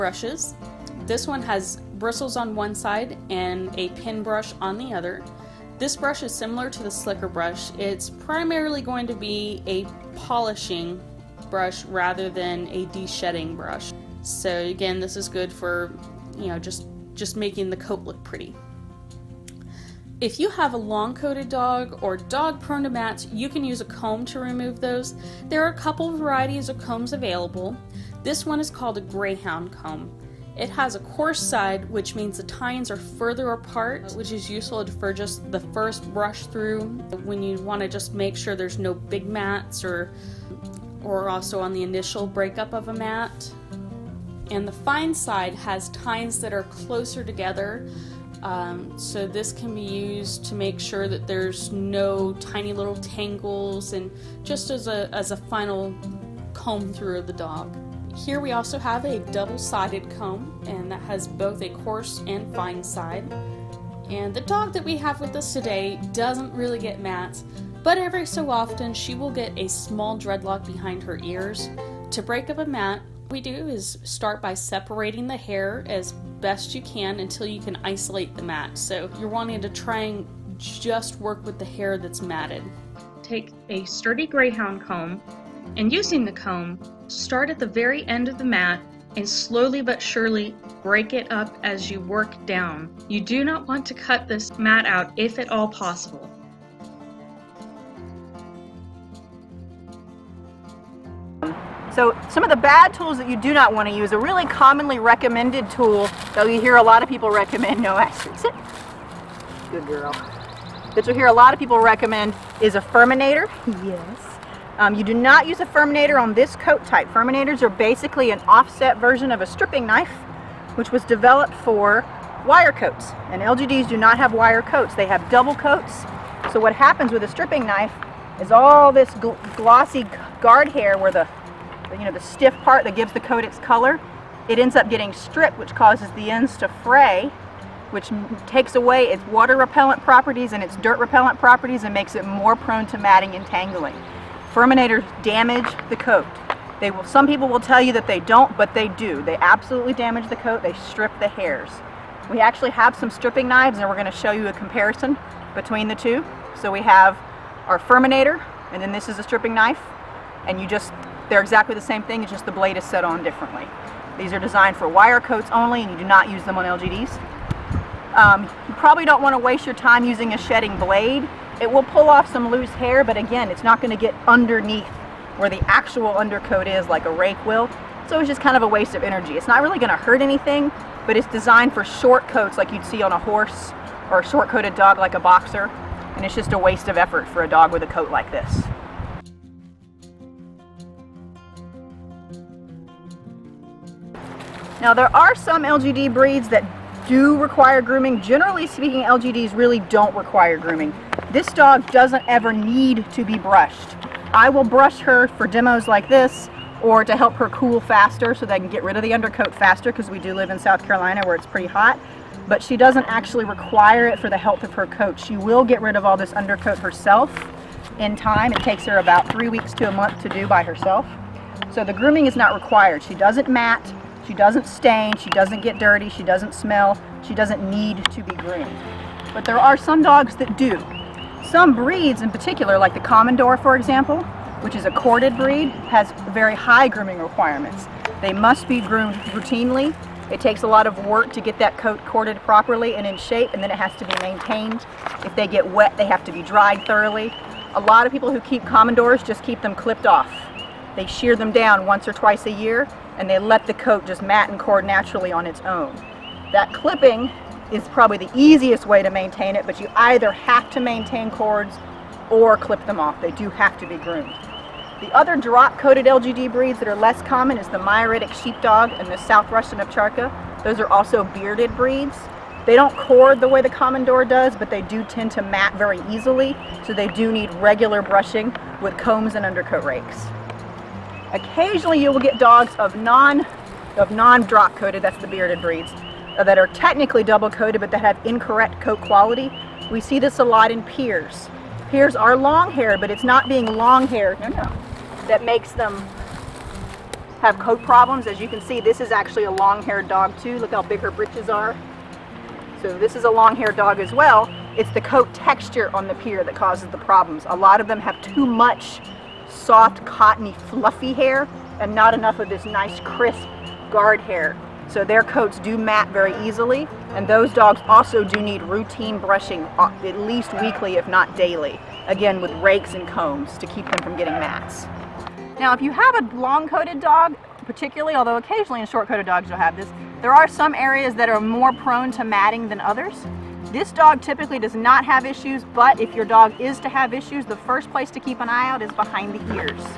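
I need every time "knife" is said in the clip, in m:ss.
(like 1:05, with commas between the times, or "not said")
1:59, 2:07, 2:39.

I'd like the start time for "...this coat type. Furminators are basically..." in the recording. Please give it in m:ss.
1:56.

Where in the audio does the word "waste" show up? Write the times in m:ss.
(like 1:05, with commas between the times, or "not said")
2:49, 2:58, 3:06.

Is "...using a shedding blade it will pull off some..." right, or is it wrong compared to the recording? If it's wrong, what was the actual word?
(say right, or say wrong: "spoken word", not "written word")
right.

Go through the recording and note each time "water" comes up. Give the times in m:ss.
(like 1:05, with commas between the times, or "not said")
2:19.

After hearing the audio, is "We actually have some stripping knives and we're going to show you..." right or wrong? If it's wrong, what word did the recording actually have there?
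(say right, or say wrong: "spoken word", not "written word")
right.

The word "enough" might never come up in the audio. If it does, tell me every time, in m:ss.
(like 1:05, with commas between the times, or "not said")
5:12.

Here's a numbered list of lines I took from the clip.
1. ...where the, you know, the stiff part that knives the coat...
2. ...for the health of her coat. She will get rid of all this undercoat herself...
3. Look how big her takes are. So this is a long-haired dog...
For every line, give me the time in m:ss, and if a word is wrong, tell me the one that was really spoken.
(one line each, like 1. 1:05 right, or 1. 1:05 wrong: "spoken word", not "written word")
1. 2:10 wrong: "gives", not "knives"
2. 3:34 right
3. 5:00 wrong: "britches", not "takes".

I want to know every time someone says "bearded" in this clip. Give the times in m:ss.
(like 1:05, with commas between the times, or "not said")
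4:31, 4:45.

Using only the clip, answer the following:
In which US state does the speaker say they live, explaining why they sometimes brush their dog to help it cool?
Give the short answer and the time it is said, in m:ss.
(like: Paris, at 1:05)
South Carolina, at 3:30.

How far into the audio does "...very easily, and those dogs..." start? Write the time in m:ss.
5:16.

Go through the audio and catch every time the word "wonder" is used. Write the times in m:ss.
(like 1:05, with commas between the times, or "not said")
not said.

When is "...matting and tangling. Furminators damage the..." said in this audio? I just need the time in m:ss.
2:22.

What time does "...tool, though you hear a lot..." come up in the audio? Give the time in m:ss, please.
1:45.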